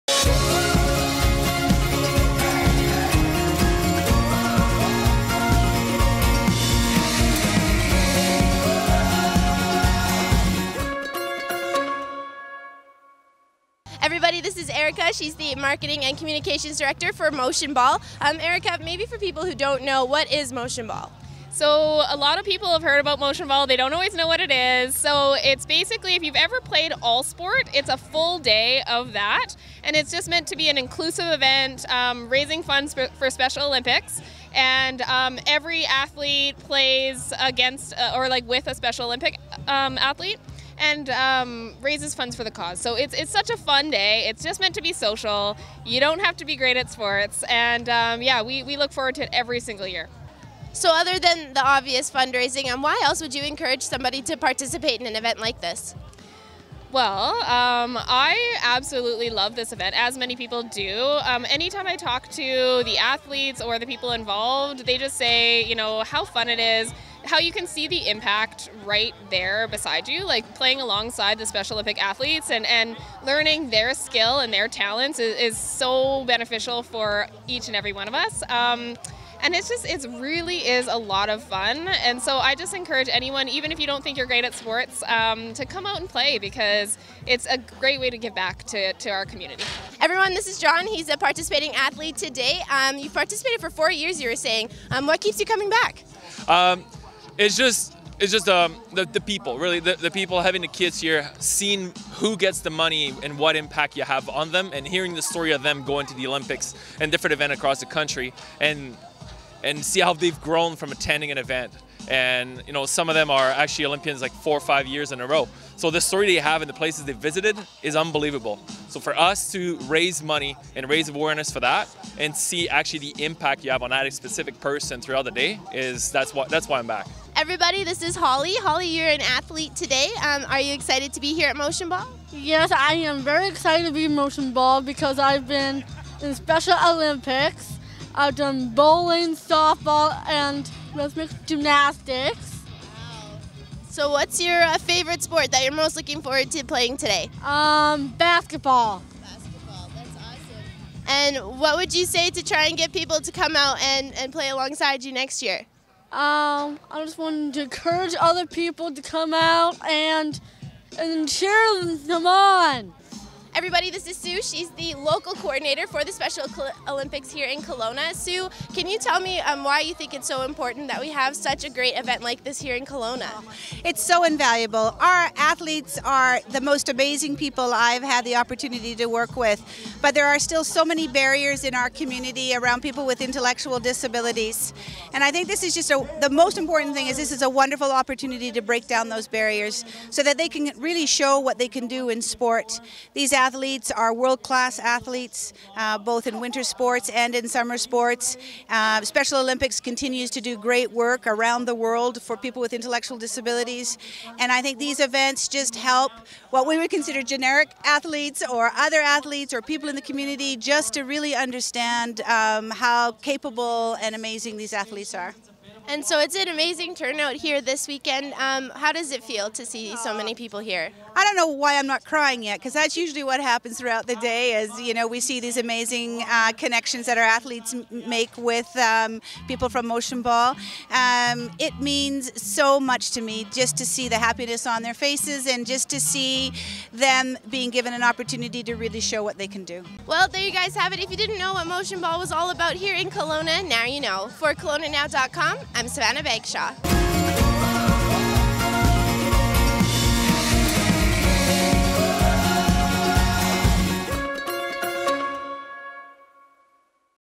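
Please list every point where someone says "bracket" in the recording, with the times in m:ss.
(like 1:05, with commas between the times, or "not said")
not said.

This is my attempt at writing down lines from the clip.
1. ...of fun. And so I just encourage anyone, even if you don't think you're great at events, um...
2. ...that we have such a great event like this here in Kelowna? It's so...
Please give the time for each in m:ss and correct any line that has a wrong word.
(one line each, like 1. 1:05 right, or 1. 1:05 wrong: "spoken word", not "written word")
1. 1:21 wrong: "sports", not "events"
2. 2:50 right.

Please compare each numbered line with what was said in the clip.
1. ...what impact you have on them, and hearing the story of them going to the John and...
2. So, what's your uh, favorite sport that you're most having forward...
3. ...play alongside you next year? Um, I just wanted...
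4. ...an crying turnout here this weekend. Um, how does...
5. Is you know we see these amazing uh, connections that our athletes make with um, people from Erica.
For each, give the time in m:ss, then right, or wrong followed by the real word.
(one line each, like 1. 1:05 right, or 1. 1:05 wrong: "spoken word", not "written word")
1. 1:43 wrong: "Olympics", not "John"
2. 2:23 wrong: "looking", not "having"
3. 2:34 right
4. 3:36 wrong: "amazing", not "crying"
5. 3:44 wrong: "Motionball", not "Erica".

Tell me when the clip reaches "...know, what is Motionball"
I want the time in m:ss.
0:19.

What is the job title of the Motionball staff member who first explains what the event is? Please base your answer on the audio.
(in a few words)
Marketing and Communications Director.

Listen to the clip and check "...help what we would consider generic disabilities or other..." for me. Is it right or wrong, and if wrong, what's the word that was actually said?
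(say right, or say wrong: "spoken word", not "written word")
wrong: "athletes", not "disabilities".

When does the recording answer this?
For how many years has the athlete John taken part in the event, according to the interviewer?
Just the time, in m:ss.
1:33.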